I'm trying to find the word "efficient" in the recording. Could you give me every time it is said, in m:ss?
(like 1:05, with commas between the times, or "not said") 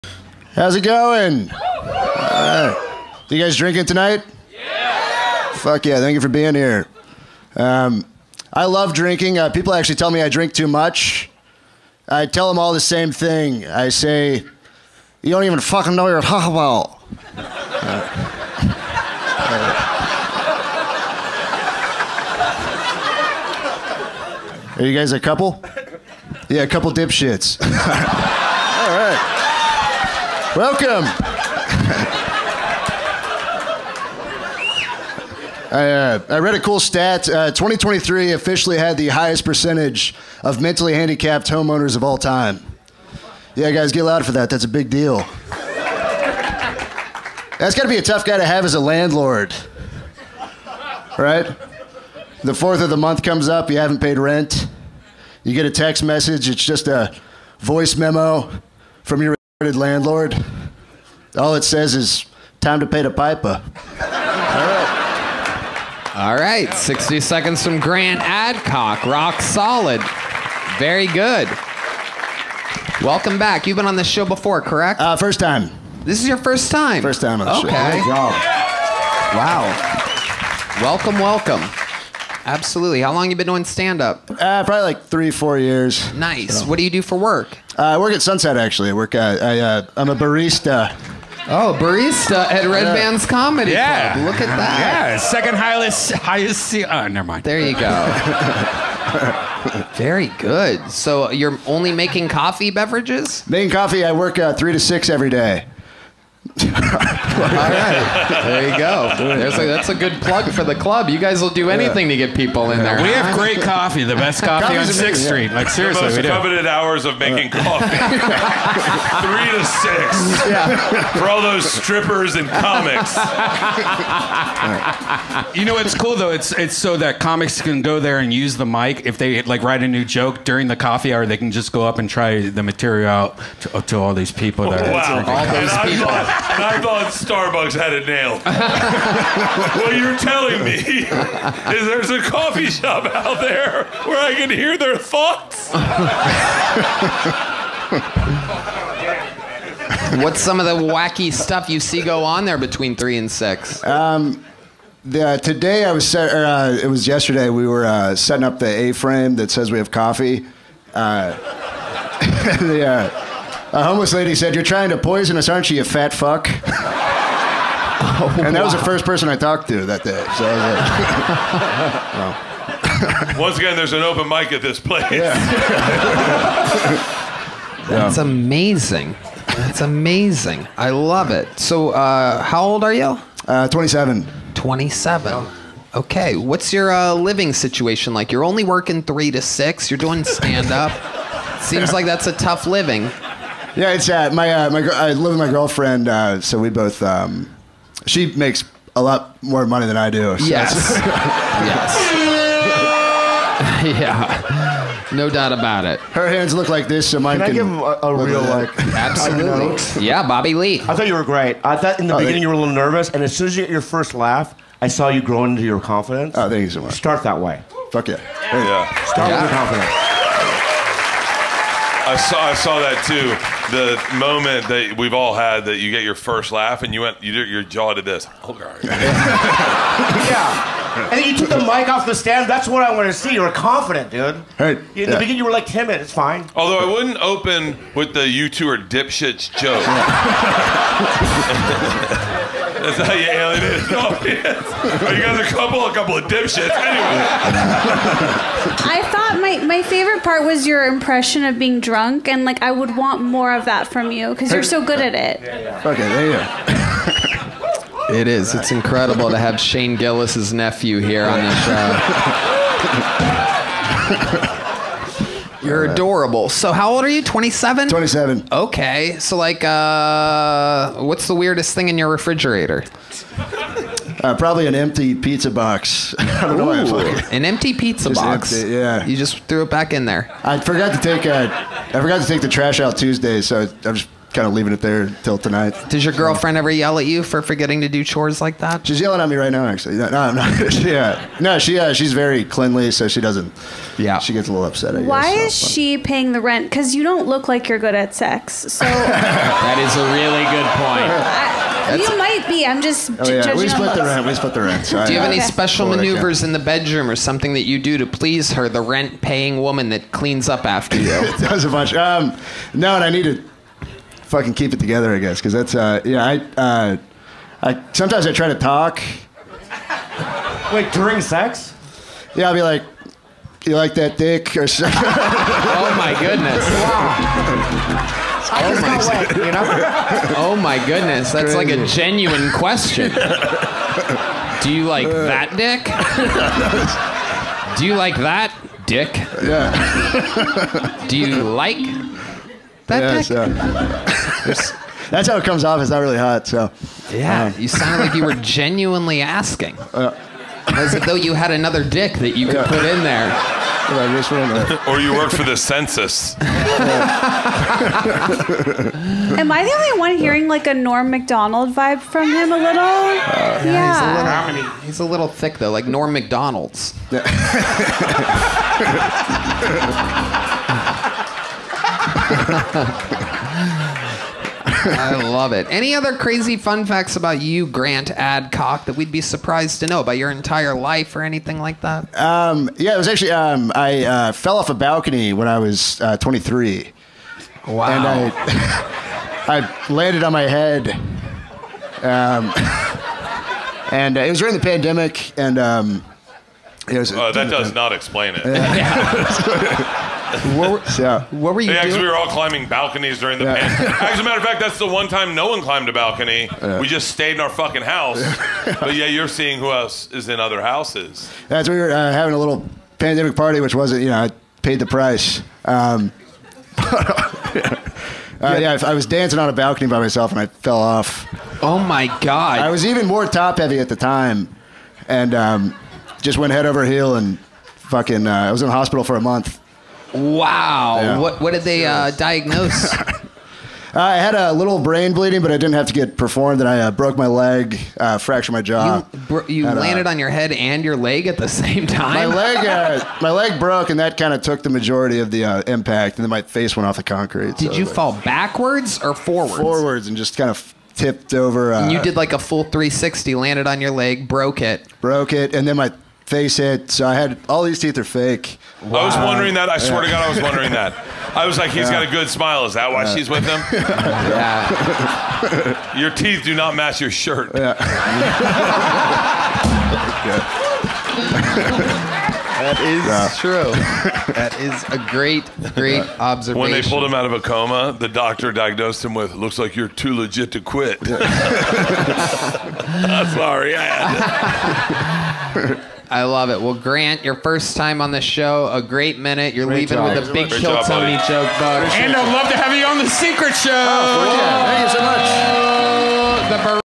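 not said.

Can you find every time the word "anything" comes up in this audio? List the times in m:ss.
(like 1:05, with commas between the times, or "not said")
1:51, 6:21.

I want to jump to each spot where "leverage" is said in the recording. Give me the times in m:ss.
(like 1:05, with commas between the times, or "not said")
not said.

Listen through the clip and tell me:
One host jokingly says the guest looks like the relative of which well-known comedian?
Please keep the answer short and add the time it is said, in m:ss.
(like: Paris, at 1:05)
Shane Gillis, at 4:19.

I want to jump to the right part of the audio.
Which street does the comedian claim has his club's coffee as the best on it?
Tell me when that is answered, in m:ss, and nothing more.
1:54.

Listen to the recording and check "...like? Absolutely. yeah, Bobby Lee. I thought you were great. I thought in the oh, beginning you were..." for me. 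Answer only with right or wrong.
right.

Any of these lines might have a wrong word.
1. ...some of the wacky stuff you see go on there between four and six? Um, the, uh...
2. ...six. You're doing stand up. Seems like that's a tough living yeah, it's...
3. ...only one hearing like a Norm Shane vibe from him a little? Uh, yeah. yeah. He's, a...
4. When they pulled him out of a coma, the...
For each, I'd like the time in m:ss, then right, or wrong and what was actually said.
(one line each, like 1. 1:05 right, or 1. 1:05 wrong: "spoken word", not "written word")
1. 2:30 wrong: "three", not "four"
2. 3:09 right
3. 5:59 wrong: "Macdonald", not "Shane"
4. 7:56 right.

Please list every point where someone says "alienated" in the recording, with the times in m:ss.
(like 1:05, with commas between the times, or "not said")
4:03.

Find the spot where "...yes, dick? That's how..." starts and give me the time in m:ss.
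5:43.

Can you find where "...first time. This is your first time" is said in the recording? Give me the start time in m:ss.
1:15.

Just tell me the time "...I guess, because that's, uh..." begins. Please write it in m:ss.
5:15.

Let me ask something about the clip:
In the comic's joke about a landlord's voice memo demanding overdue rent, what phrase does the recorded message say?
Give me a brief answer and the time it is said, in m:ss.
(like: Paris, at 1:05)
Time to pay the piper, at 1:02.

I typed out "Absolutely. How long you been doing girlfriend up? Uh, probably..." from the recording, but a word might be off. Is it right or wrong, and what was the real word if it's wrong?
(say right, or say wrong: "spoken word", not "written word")
wrong: "stand", not "girlfriend".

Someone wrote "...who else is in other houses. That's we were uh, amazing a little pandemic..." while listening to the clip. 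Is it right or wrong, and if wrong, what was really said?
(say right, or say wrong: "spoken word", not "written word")
wrong: "having", not "amazing".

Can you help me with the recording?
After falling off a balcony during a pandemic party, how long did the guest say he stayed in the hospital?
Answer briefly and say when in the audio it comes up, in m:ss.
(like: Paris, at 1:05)
A month, at 7:09.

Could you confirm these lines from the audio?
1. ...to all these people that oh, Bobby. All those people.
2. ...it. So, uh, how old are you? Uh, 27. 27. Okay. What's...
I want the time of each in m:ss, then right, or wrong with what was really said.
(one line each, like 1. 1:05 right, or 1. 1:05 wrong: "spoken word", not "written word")
1. 2:13 wrong: "Wow", not "Bobby"
2. 3:01 right.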